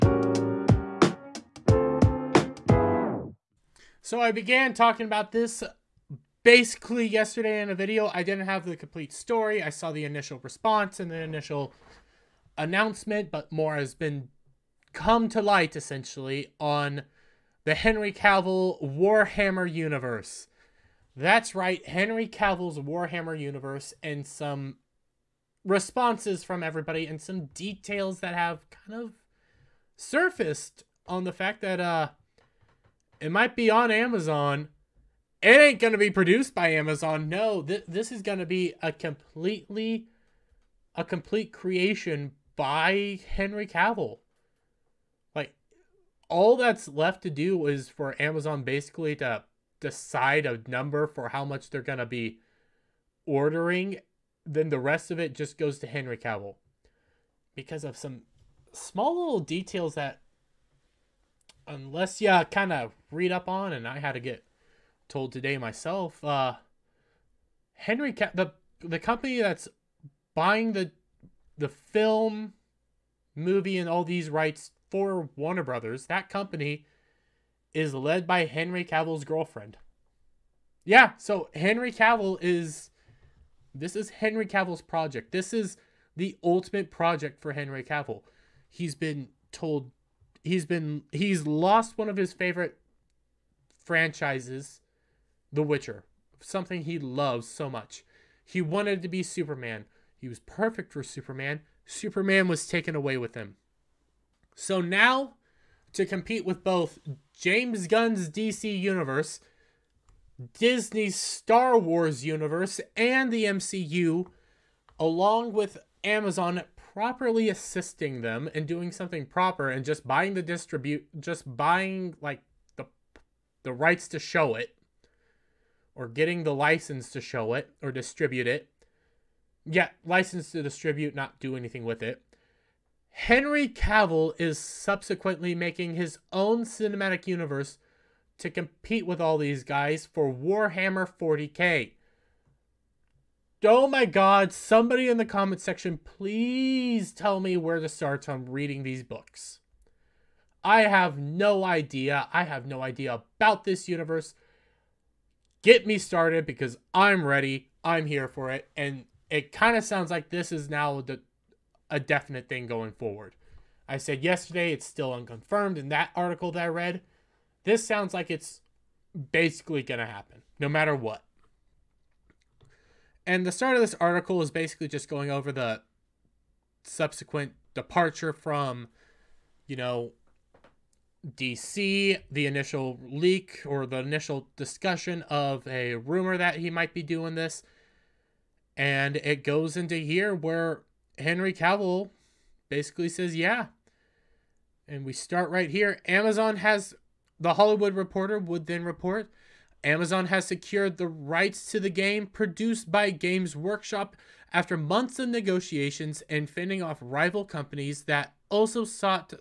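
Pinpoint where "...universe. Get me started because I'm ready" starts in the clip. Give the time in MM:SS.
02:33.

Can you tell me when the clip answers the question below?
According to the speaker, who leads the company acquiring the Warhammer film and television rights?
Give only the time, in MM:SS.
01:18.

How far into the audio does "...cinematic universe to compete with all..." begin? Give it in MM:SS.
02:16.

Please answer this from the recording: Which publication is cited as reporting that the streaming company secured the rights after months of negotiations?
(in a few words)
The Hollywood Reporter.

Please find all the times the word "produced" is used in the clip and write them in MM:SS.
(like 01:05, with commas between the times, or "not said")
00:36, 03:22.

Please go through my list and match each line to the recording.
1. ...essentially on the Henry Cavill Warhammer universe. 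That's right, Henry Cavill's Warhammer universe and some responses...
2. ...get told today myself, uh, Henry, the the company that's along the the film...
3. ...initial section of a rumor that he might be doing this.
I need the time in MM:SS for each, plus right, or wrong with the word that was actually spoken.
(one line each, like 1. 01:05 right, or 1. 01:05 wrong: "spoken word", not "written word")
1. 00:15 right
2. 01:04 wrong: "buying", not "along"
3. 03:03 wrong: "discussion", not "section".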